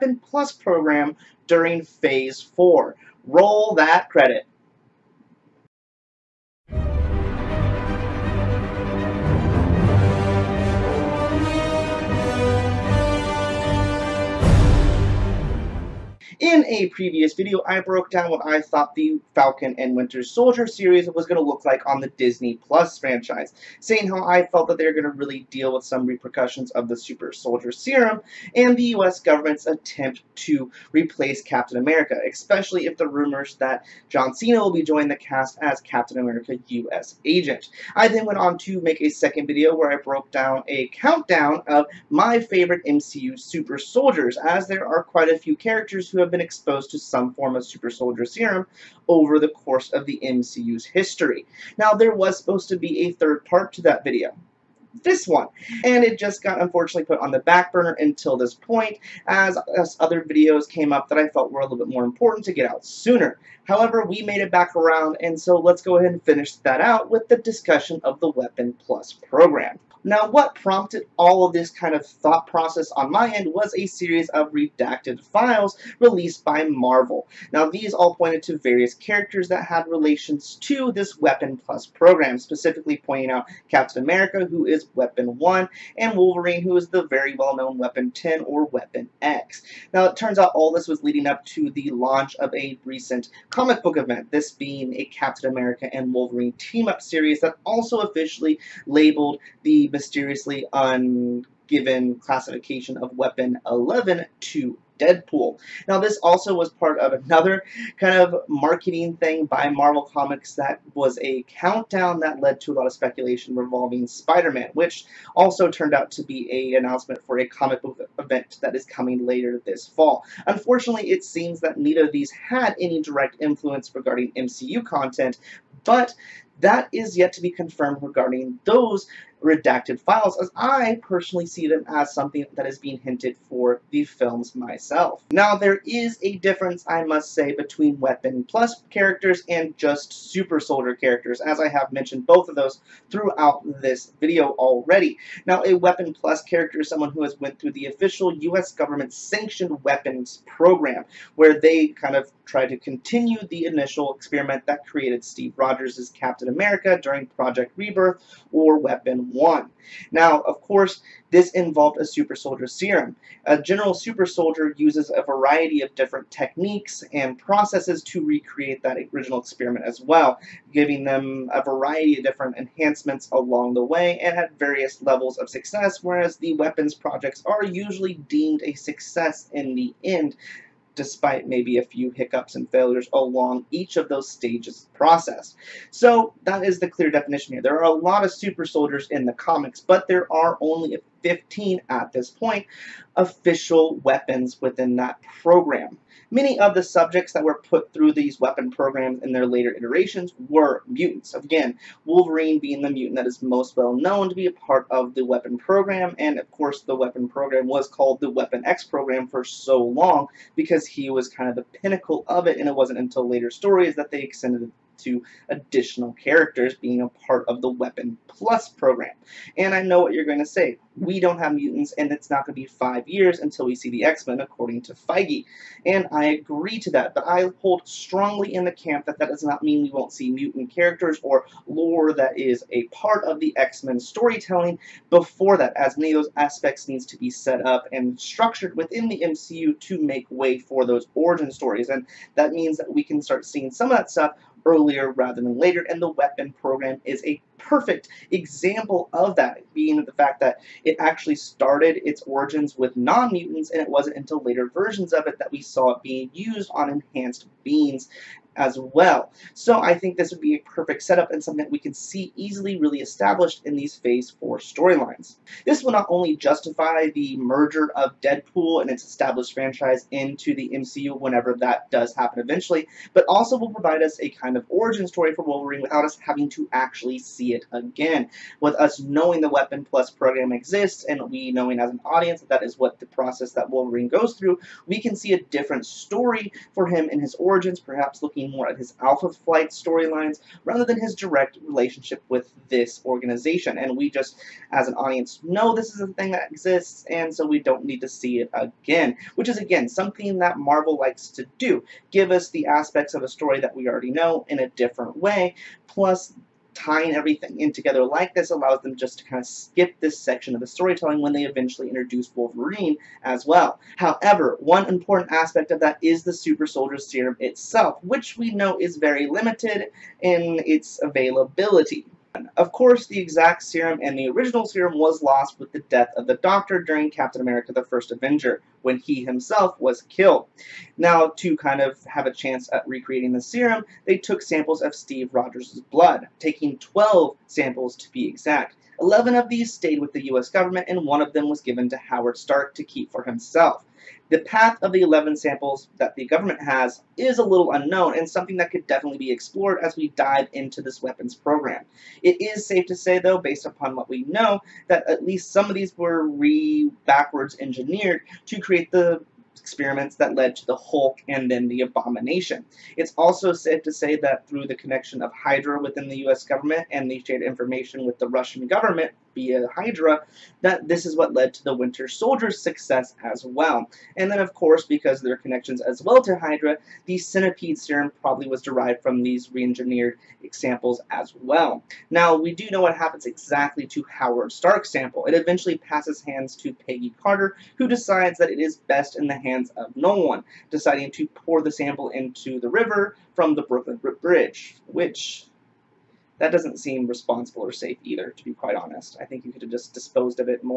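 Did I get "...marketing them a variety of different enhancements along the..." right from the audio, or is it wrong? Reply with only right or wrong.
wrong.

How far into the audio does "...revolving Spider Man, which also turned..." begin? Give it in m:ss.
1:53.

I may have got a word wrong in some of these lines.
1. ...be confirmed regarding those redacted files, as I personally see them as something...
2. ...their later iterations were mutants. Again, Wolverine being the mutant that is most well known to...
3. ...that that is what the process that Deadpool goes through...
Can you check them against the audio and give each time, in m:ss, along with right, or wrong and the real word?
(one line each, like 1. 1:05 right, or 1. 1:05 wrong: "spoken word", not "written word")
1. 2:07 right
2. 3:19 right
3. 4:42 wrong: "Wolverine", not "Deadpool".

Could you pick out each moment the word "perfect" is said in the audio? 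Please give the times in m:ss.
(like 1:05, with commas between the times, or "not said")
4:07, 4:20.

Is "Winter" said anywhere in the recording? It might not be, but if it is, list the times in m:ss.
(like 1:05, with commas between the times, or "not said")
0:19, 6:11.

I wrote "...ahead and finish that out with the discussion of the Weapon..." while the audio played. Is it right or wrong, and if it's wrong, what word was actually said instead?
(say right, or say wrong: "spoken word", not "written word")
right.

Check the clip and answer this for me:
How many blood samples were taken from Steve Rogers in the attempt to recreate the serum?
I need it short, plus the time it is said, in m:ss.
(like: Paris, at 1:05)
12, at 5:36.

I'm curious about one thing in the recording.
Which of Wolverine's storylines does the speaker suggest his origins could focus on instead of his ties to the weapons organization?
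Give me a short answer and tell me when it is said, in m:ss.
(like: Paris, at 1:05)
Alpha Flight, at 4:49.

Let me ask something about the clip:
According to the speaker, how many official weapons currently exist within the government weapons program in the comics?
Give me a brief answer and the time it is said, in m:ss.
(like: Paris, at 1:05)
15, at 3:11.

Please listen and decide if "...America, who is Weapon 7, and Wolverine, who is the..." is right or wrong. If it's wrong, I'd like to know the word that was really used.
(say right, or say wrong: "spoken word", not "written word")
wrong: "1", not "7".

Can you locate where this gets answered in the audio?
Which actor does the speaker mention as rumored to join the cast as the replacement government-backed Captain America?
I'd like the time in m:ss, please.
0:34.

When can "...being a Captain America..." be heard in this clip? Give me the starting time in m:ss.
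1:34.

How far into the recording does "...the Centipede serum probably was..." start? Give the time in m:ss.
6:17.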